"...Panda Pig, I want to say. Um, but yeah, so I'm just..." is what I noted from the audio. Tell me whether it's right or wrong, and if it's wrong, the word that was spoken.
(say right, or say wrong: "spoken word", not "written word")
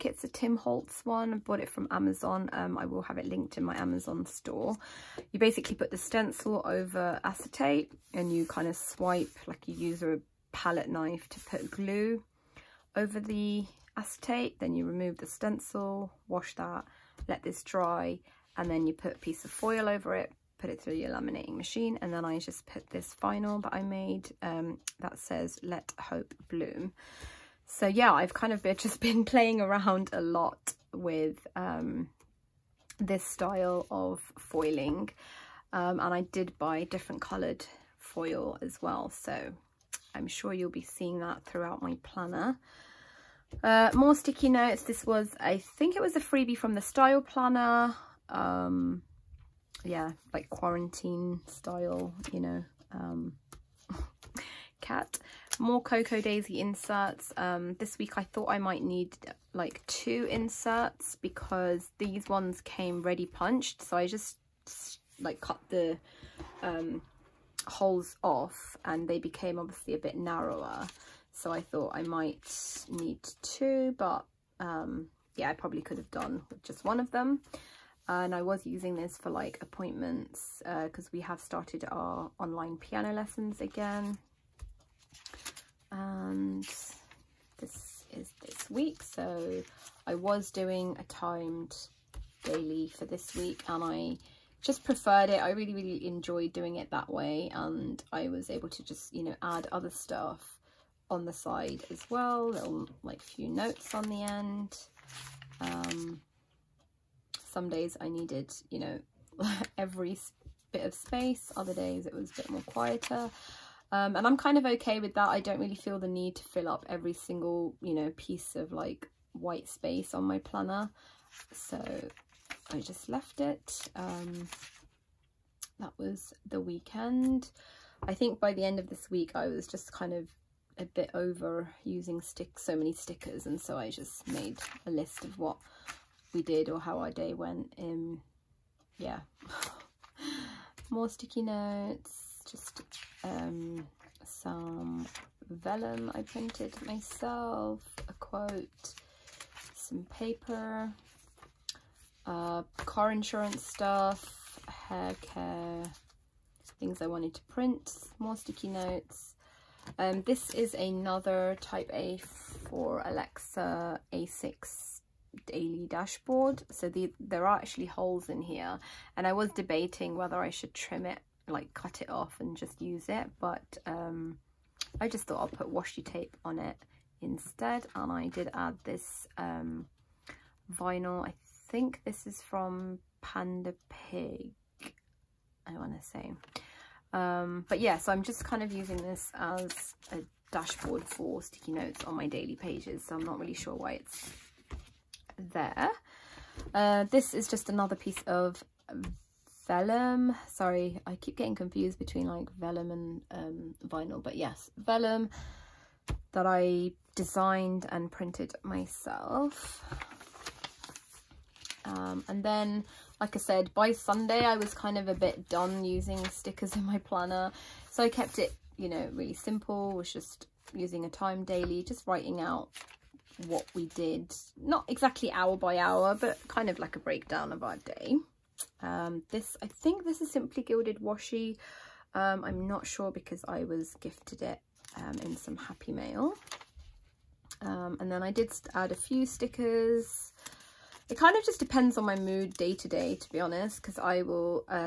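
right.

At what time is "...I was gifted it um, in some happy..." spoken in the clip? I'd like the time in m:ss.
3:53.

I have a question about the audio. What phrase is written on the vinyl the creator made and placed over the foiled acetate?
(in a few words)
Let Hope Bloom.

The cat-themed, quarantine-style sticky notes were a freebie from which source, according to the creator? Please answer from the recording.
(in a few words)
The Style Planner.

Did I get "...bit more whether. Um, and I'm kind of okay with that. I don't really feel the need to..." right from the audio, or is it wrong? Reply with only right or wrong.
wrong.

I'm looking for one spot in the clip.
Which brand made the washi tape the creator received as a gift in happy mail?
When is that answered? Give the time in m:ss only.
3:50.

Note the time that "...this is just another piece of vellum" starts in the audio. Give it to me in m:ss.
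3:17.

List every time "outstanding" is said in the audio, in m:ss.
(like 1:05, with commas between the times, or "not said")
not said.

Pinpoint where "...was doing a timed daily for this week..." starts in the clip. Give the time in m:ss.
1:30.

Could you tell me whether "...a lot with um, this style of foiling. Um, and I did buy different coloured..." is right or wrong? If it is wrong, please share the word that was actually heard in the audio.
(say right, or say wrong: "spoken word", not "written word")
right.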